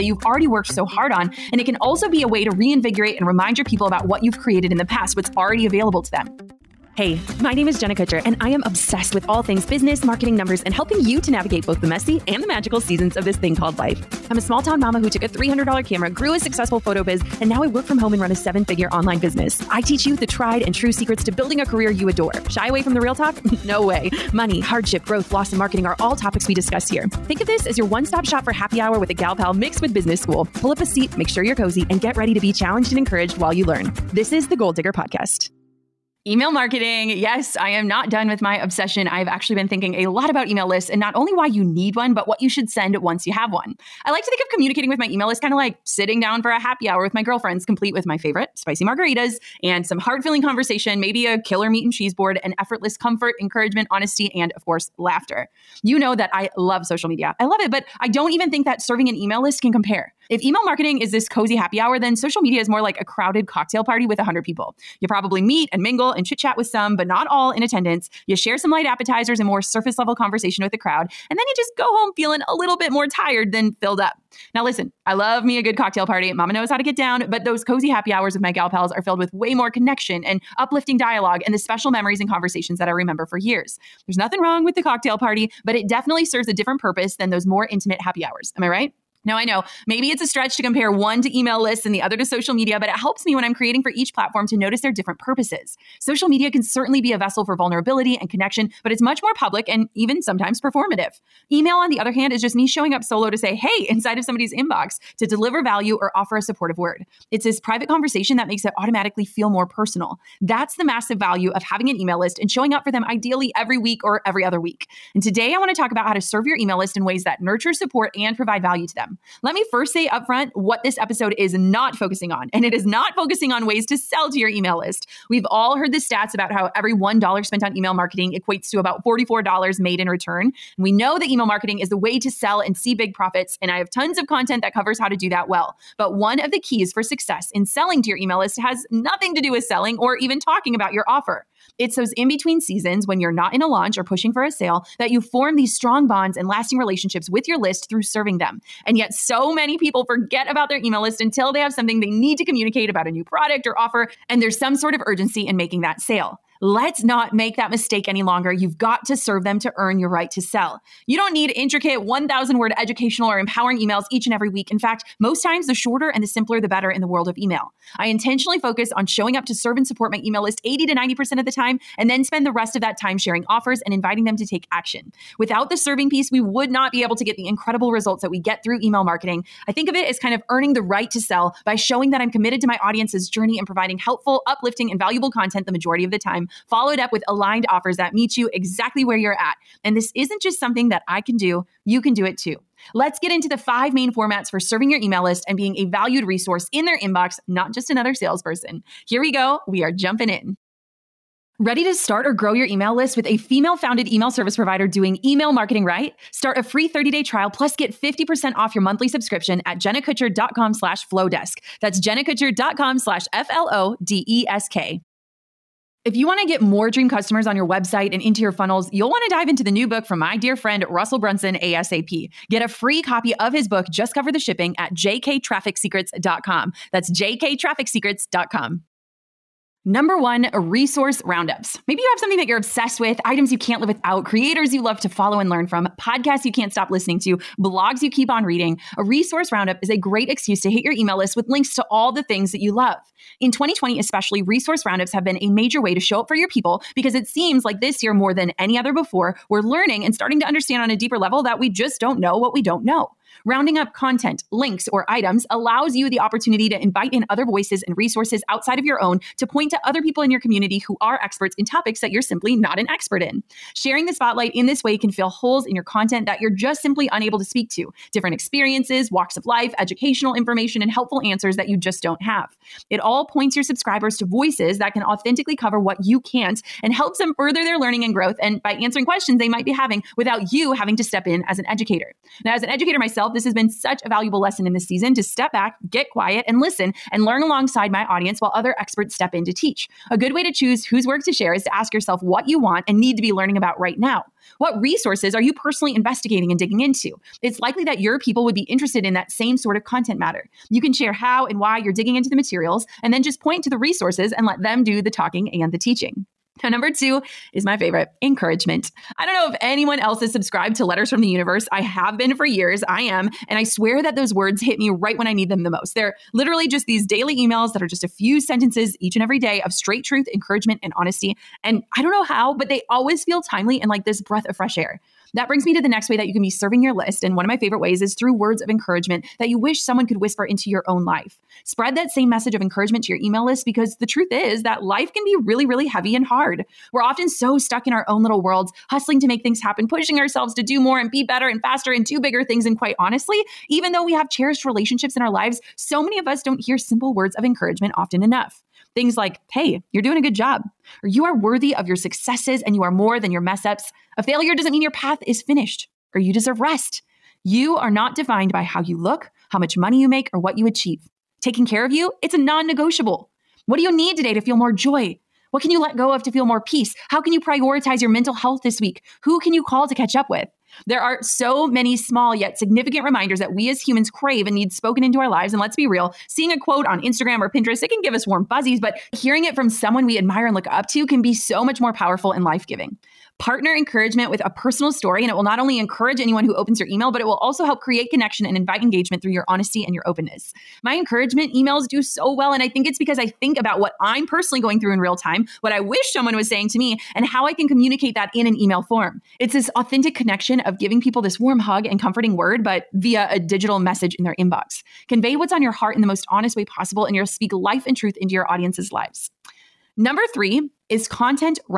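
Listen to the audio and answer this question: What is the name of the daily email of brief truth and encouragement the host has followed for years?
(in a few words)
Letters from the Universe.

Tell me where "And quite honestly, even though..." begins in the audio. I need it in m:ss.
5:42.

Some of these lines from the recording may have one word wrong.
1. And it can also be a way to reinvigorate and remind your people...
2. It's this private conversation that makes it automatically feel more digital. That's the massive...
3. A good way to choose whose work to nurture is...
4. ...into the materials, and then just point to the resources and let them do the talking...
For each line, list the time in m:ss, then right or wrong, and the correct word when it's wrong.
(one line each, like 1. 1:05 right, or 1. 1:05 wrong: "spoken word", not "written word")
1. 0:01 right
2. 1:47 wrong: "personal", not "digital"
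3. 4:50 wrong: "share", not "nurture"
4. 5:02 right.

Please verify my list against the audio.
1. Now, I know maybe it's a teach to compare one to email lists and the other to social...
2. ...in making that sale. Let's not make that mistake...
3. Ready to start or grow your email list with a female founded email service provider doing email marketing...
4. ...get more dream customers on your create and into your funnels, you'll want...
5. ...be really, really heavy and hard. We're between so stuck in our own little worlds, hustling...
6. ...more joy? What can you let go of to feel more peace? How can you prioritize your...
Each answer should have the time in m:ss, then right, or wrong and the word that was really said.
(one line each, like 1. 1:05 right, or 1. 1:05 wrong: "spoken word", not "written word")
1. 1:29 wrong: "stretch", not "teach"
2. 2:35 right
3. 3:21 right
4. 3:36 wrong: "website", not "create"
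5. 5:35 wrong: "often", not "between"
6. 6:04 right.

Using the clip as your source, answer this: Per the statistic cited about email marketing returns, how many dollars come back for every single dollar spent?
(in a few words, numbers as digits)
$44.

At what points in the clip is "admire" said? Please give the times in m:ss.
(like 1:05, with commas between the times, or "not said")
6:20.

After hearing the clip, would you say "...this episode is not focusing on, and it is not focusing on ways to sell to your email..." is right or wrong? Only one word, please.
right.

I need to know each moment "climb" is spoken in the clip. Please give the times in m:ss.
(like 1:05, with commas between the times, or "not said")
not said.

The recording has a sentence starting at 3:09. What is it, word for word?
And this isn't just something that I can do, you can do it too.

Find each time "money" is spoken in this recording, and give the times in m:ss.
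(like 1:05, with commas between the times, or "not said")
0:24, 5:59.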